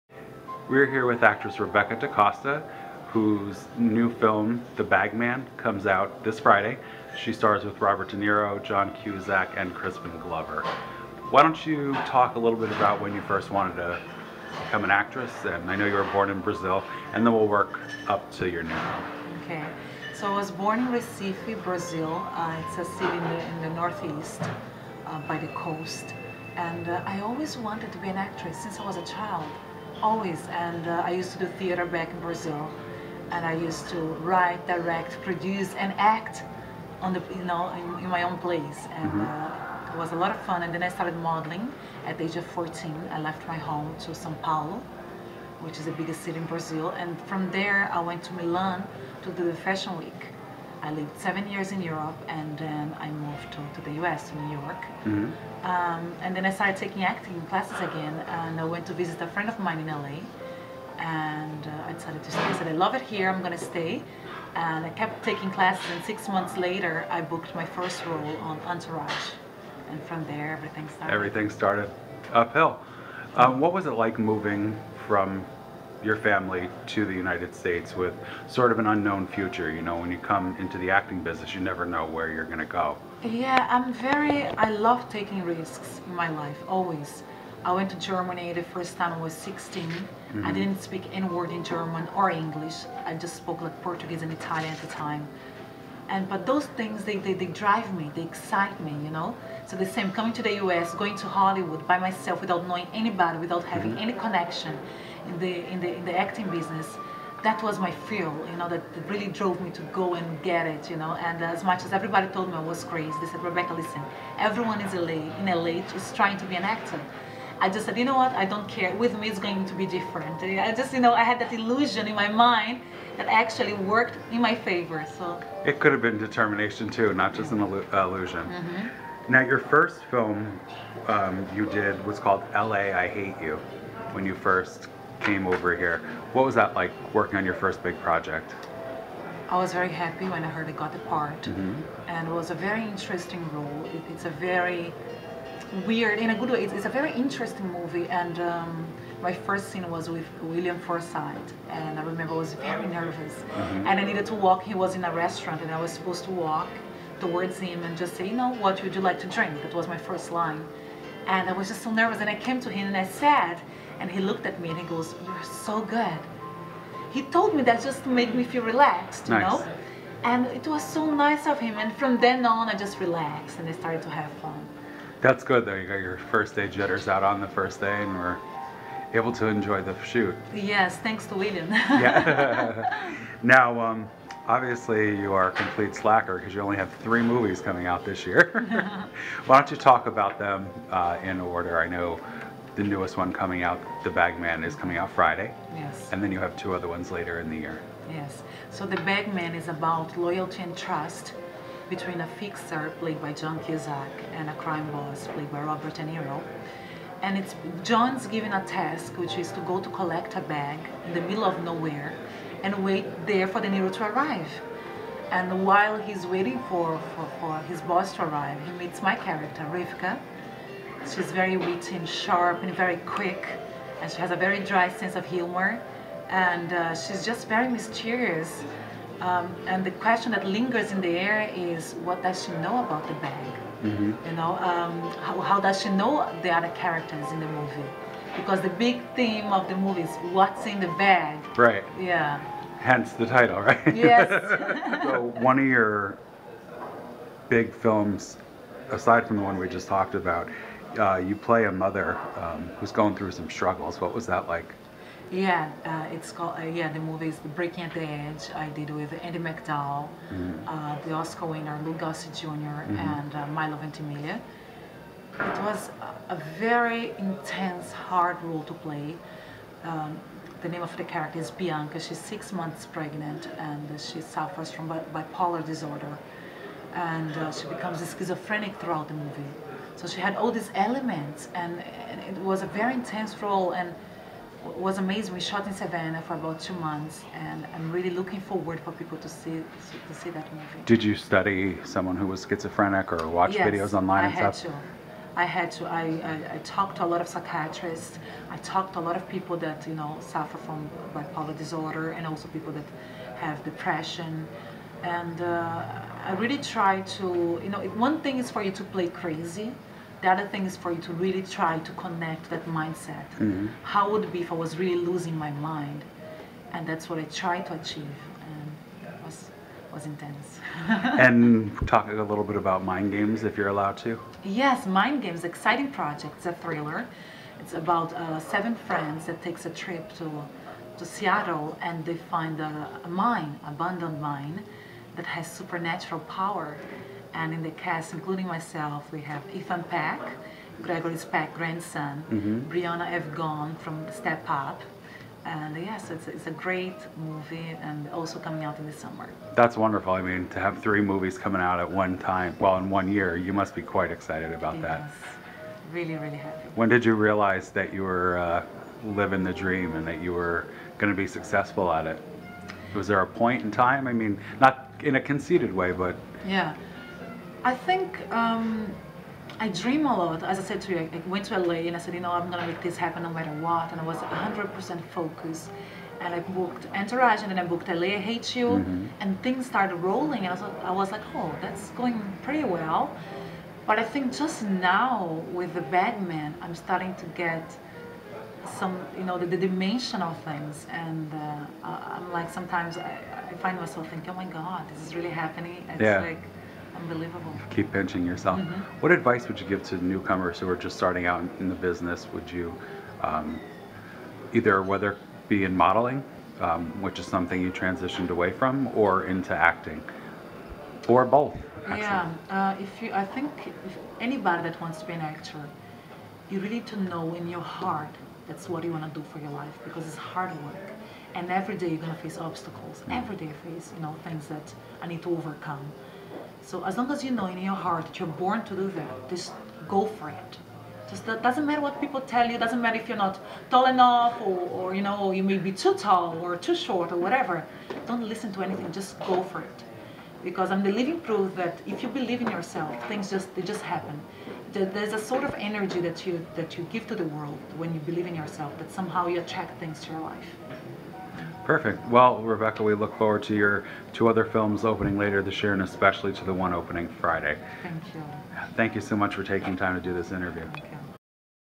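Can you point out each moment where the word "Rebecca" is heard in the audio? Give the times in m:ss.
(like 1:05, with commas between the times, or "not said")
0:01, 1:53, 7:32.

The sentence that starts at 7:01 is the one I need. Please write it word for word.
And every day you're going to face obstacles.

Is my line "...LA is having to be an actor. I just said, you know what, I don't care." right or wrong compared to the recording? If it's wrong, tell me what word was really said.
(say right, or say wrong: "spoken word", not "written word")
wrong: "trying", not "having".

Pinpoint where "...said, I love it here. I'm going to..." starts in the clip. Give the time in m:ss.
1:02.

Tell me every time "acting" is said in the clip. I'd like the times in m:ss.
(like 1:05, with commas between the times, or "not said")
0:57, 1:20, 1:46, 6:49.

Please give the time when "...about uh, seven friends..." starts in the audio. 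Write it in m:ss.
5:27.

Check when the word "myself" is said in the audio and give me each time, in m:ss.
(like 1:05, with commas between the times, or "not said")
1:41, 5:38, 6:33.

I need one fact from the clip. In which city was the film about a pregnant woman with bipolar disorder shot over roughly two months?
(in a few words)
Savannah.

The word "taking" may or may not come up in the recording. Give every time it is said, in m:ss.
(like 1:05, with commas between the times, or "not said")
0:56, 1:05, 1:25, 7:39.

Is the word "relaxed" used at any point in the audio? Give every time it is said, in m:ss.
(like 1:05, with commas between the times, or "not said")
2:48, 2:52.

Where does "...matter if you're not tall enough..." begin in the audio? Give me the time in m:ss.
7:12.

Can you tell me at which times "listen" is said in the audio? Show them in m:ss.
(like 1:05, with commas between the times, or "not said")
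1:53, 7:18.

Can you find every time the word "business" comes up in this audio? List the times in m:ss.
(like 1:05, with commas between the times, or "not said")
1:21, 1:46, 6:41.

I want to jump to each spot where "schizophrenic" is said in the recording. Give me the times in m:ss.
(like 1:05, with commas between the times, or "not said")
4:37, 4:52.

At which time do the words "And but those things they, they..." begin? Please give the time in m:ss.
1:36.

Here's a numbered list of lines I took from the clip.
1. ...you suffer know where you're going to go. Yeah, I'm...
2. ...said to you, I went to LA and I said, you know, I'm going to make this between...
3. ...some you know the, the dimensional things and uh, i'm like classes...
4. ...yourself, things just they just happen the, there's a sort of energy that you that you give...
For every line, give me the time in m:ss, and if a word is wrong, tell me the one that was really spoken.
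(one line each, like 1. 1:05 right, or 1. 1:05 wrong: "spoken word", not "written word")
1. 1:21 wrong: "never", not "suffer"
2. 6:10 wrong: "happen", not "between"
3. 6:28 wrong: "sometimes", not "classes"
4. 7:22 right.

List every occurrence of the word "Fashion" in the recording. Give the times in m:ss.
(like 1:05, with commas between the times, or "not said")
0:49.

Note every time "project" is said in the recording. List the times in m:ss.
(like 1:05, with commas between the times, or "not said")
2:17, 5:25.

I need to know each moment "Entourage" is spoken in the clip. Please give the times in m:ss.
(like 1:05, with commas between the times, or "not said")
1:08, 6:16.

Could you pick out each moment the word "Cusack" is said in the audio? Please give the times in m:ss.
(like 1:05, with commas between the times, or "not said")
0:09, 3:23.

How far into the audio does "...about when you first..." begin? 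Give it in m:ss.
0:12.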